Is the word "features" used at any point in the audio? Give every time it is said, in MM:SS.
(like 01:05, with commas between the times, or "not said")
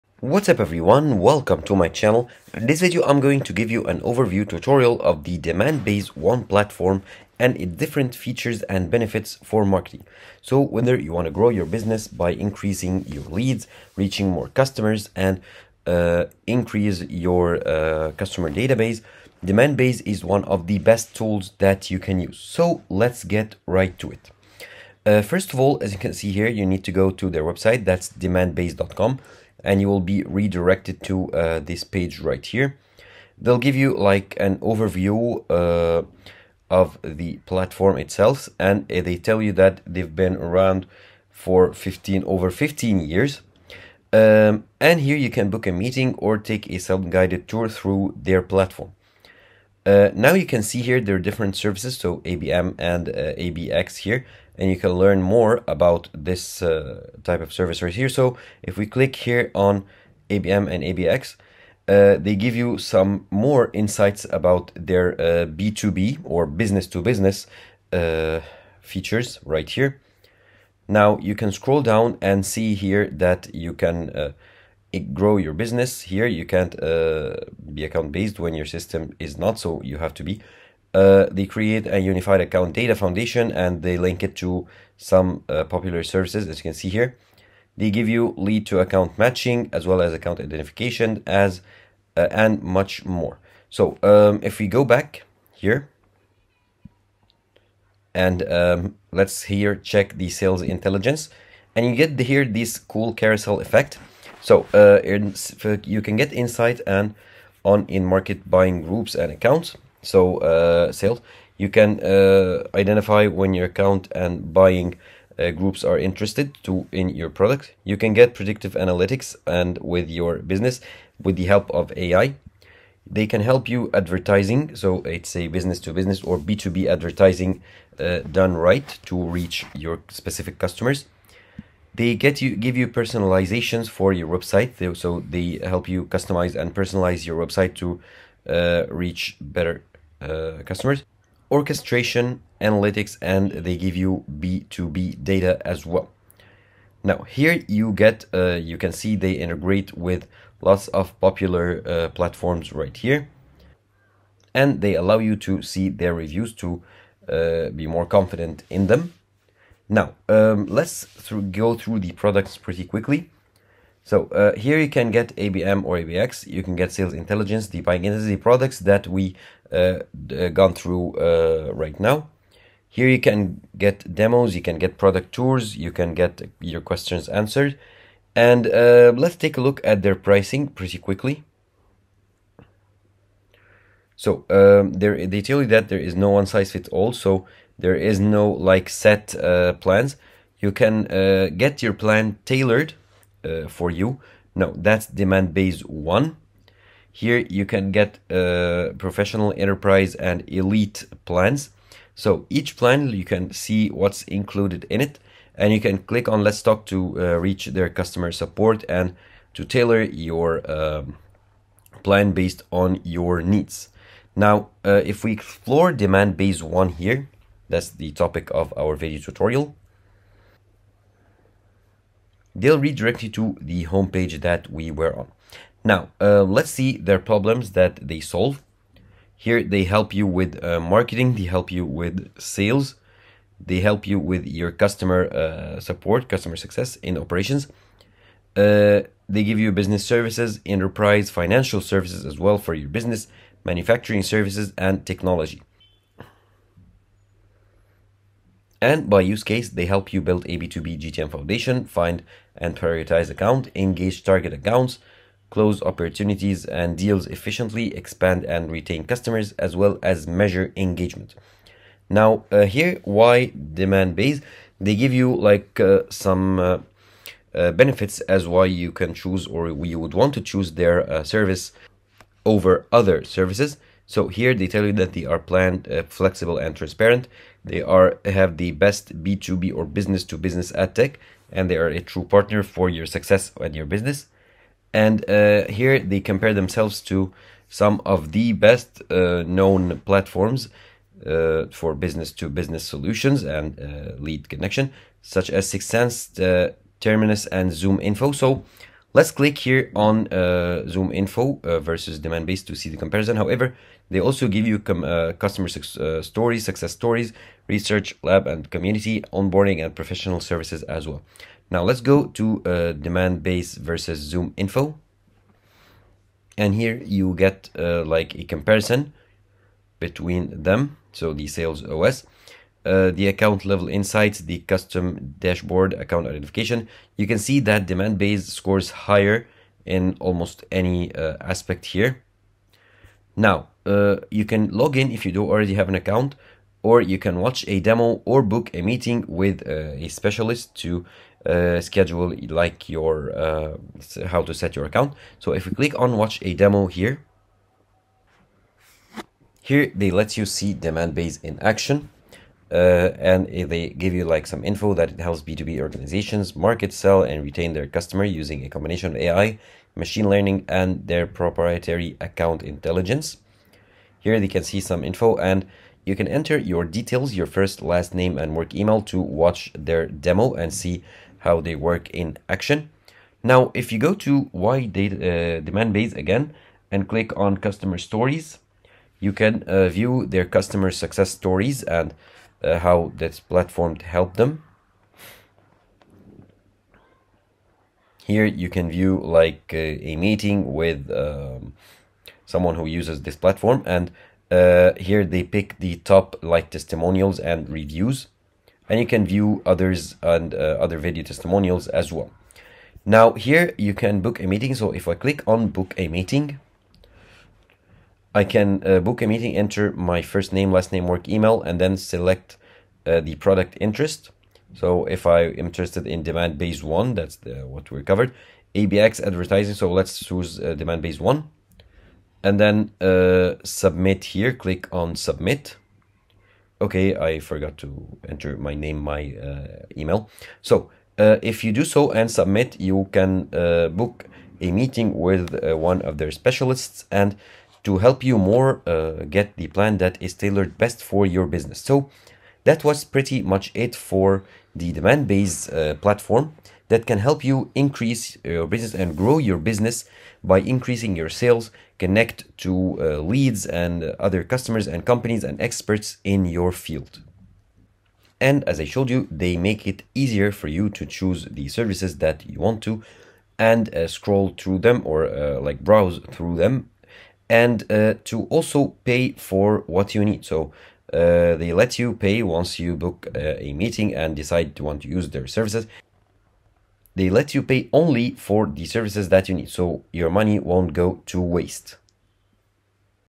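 00:08, 01:08.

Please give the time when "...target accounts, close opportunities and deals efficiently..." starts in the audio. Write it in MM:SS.
04:14.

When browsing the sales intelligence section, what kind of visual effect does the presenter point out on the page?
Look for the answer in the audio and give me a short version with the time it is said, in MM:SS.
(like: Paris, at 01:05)
carousel effect, at 01:43.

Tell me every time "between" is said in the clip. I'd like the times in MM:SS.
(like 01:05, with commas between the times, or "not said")
05:19.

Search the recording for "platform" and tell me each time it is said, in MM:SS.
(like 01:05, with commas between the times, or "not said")
00:06, 00:37, 00:48, 02:32, 04:50, 06:23, 06:33, 07:25.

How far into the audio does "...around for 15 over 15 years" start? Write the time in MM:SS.
00:40.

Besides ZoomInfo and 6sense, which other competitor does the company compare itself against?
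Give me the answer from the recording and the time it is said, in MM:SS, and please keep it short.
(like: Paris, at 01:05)
Terminus, at 04:56.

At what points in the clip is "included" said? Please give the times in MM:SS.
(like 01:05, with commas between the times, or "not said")
03:24.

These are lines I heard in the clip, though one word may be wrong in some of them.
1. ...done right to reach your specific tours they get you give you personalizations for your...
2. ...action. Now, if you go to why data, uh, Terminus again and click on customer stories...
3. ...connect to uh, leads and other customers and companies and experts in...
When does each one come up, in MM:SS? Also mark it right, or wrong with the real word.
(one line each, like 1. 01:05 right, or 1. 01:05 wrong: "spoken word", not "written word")
1. 02:08 wrong: "customers", not "tours"
2. 06:12 wrong: "Demandbase", not "Terminus"
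3. 07:31 right.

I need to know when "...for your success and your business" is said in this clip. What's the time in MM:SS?
04:42.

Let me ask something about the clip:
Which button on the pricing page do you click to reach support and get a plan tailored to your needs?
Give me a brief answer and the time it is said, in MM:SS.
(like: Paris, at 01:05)
Let's Talk, at 03:26.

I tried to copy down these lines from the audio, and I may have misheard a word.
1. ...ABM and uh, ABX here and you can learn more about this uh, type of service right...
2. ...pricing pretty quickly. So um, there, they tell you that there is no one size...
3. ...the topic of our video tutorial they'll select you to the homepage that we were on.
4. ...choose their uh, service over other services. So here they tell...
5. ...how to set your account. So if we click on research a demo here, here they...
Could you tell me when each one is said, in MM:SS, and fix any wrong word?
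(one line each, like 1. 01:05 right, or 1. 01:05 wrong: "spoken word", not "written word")
1. 00:52 right
2. 03:00 right
3. 03:37 wrong: "redirect", not "select"
4. 04:30 right
5. 05:44 wrong: "watch", not "research".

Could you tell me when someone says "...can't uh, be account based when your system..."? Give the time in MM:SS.
01:16.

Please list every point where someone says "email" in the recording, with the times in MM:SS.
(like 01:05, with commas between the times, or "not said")
06:08, 06:51, 07:09.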